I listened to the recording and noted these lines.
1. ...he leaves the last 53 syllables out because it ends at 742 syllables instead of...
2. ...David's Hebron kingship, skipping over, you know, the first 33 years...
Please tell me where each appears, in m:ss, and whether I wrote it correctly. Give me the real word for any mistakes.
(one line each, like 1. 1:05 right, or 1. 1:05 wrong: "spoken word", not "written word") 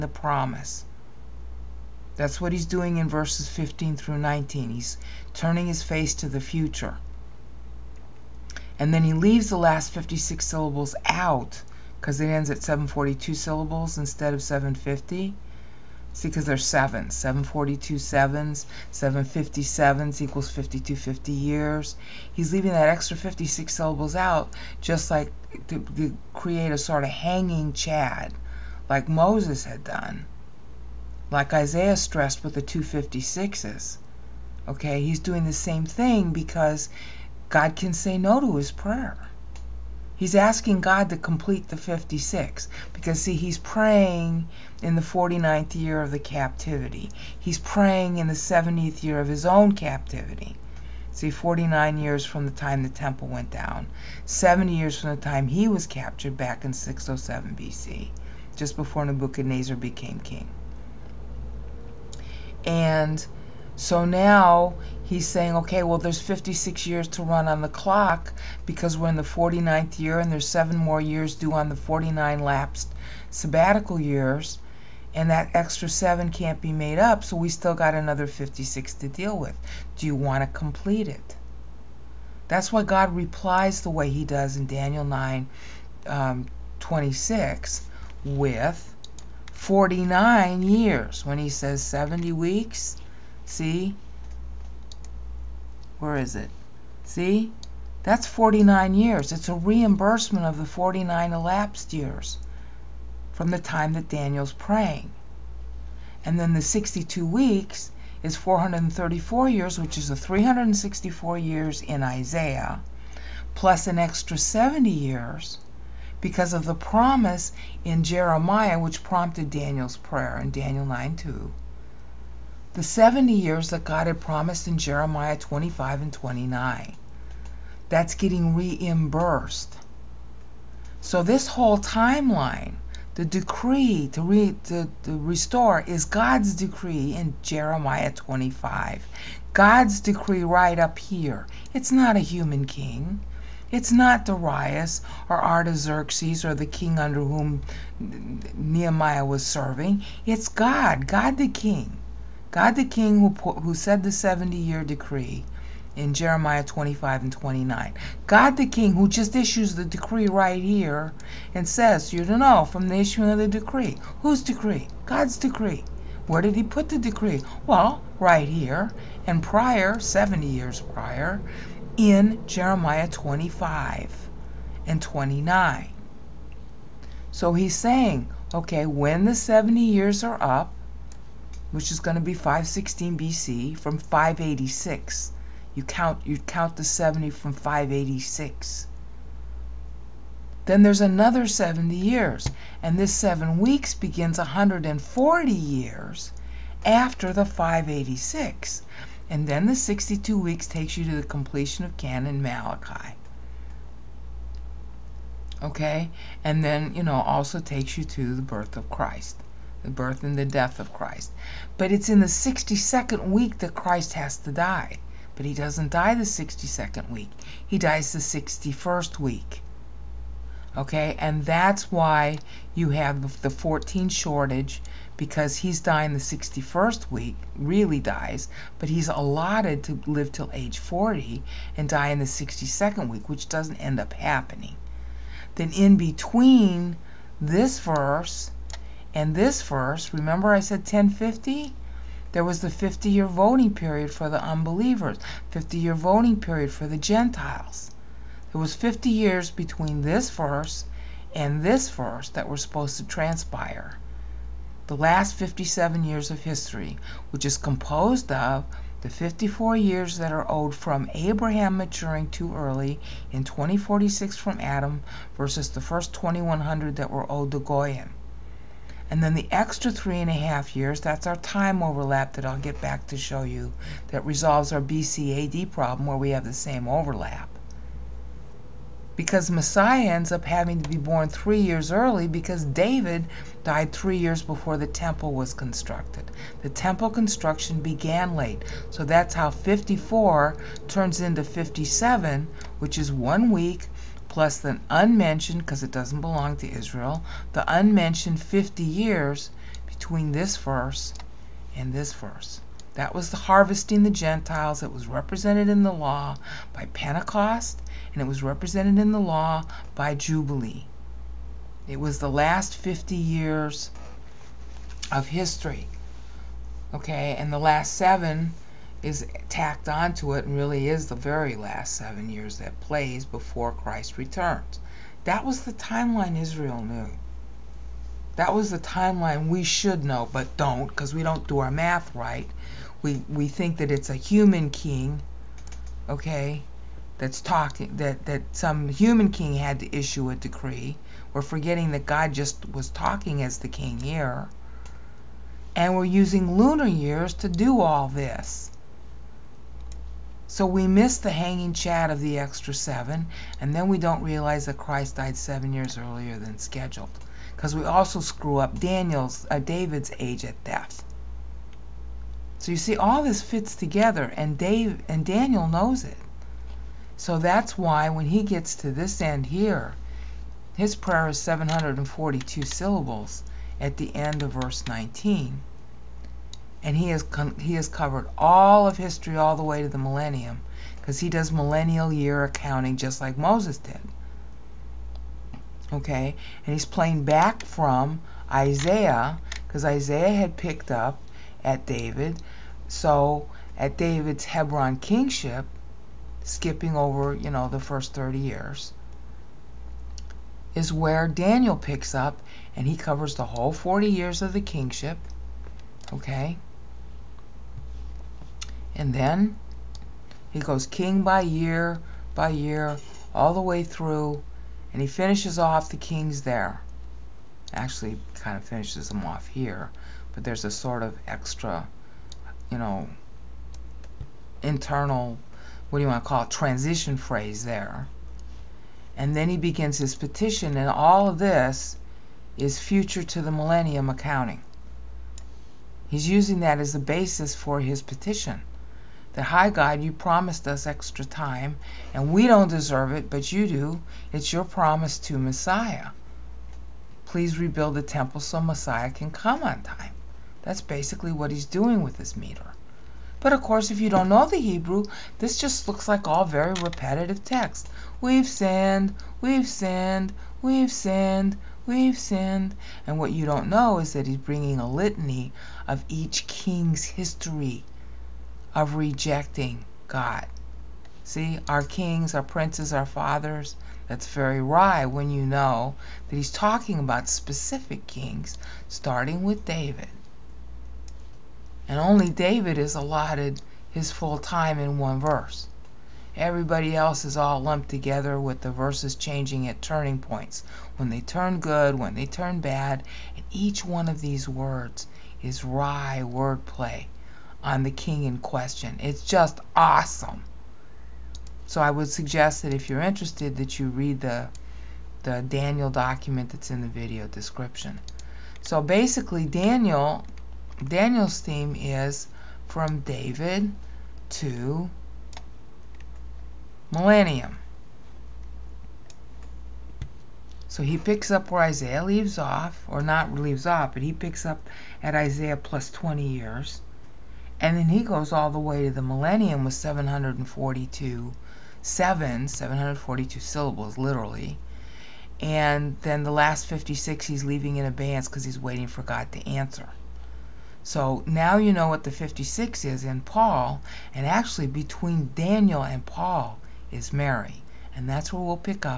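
1. 0:09 wrong: "56", not "53"
2. 6:33 wrong: "30", not "33".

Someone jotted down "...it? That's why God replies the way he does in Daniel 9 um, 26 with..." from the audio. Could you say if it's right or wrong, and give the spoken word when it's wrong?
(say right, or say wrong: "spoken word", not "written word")
right.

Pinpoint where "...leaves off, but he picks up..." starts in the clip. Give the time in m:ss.
8:43.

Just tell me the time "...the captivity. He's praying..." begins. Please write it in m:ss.
0:46.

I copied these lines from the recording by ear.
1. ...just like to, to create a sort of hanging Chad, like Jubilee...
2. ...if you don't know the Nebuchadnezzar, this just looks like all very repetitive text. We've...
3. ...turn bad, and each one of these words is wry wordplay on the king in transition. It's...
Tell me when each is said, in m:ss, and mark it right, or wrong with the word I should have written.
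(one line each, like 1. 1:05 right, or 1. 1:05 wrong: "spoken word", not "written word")
1. 0:24 wrong: "Moses", not "Jubilee"
2. 7:33 wrong: "Hebrew", not "Nebuchadnezzar"
3. 8:12 wrong: "question", not "transition".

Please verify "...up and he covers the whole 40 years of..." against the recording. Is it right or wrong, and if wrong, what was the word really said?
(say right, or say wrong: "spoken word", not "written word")
right.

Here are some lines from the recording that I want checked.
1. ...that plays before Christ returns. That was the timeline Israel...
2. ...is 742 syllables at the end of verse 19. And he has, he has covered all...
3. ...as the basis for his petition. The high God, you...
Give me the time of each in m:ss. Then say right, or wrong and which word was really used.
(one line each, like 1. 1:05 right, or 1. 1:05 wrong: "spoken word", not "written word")
1. 5:22 right
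2. 6:11 right
3. 7:16 right.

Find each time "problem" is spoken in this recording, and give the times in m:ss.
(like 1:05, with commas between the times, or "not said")
4:35.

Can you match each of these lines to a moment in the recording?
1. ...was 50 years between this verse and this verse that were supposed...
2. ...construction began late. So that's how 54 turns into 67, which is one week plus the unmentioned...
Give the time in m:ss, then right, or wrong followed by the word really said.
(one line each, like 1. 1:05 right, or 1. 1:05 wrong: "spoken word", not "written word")
1. 4:08 right
2. 4:47 wrong: "57", not "67".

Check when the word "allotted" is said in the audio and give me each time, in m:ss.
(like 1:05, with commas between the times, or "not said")
3:49, 8:02.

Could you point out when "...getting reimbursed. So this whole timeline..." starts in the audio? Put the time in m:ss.
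2:08.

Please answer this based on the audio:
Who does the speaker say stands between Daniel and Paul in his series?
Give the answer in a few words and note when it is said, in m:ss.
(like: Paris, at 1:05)
Mary, at 9:07.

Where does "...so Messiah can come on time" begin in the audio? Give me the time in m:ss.
7:28.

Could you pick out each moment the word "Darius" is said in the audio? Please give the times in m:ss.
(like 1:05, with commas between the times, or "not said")
2:24.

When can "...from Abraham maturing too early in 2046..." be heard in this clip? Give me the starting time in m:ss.
4:20.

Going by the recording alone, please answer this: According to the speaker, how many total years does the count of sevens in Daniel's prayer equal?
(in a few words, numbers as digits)
5250 years.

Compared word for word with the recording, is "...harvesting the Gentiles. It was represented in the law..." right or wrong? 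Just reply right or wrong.
right.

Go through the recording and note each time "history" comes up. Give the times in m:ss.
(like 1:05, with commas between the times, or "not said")
4:16, 5:15, 6:18, 7:47.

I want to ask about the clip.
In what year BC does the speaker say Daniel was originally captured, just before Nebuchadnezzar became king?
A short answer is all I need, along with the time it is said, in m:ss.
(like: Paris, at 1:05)
607 BC, at 0:56.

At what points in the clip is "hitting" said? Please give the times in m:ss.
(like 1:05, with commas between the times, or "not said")
not said.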